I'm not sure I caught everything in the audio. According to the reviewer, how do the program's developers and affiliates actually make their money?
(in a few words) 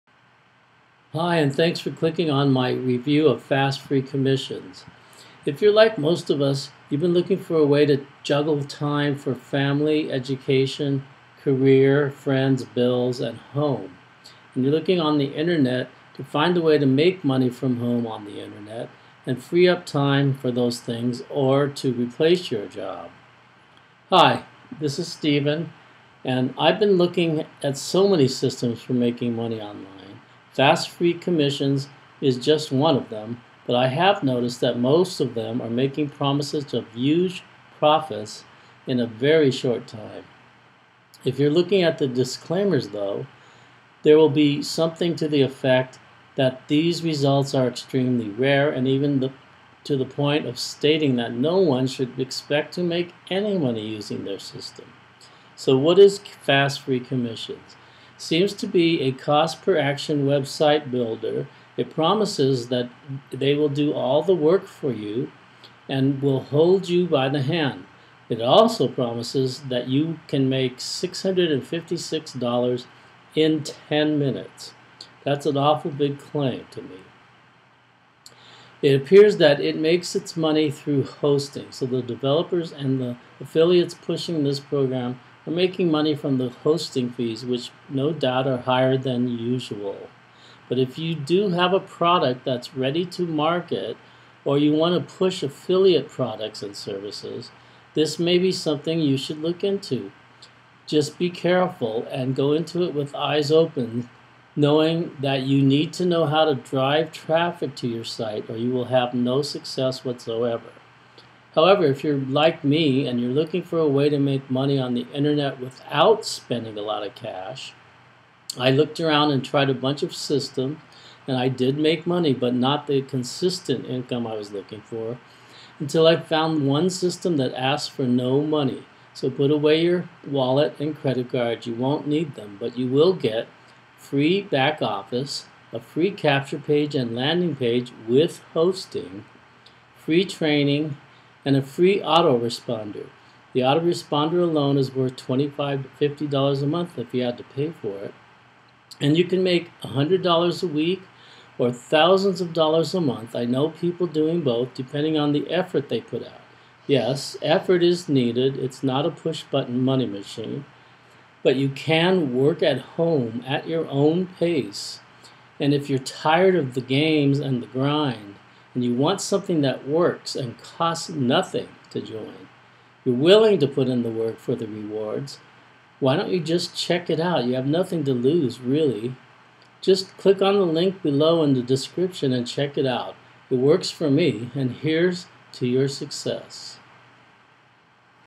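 hosting fees.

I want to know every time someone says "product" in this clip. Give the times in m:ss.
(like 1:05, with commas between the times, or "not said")
1:31, 1:36.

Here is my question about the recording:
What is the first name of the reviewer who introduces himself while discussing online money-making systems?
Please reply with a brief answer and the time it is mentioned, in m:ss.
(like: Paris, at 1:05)
Stephen, at 0:25.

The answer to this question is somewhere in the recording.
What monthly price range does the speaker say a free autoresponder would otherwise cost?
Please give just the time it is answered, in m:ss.
2:25.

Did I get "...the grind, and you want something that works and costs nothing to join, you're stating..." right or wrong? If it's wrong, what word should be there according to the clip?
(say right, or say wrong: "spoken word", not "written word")
wrong: "willing", not "stating".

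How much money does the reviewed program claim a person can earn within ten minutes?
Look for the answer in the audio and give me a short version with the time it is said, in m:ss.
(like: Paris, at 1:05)
$656, at 1:10.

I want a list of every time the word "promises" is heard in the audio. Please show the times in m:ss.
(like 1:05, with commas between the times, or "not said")
0:36, 1:01, 1:08.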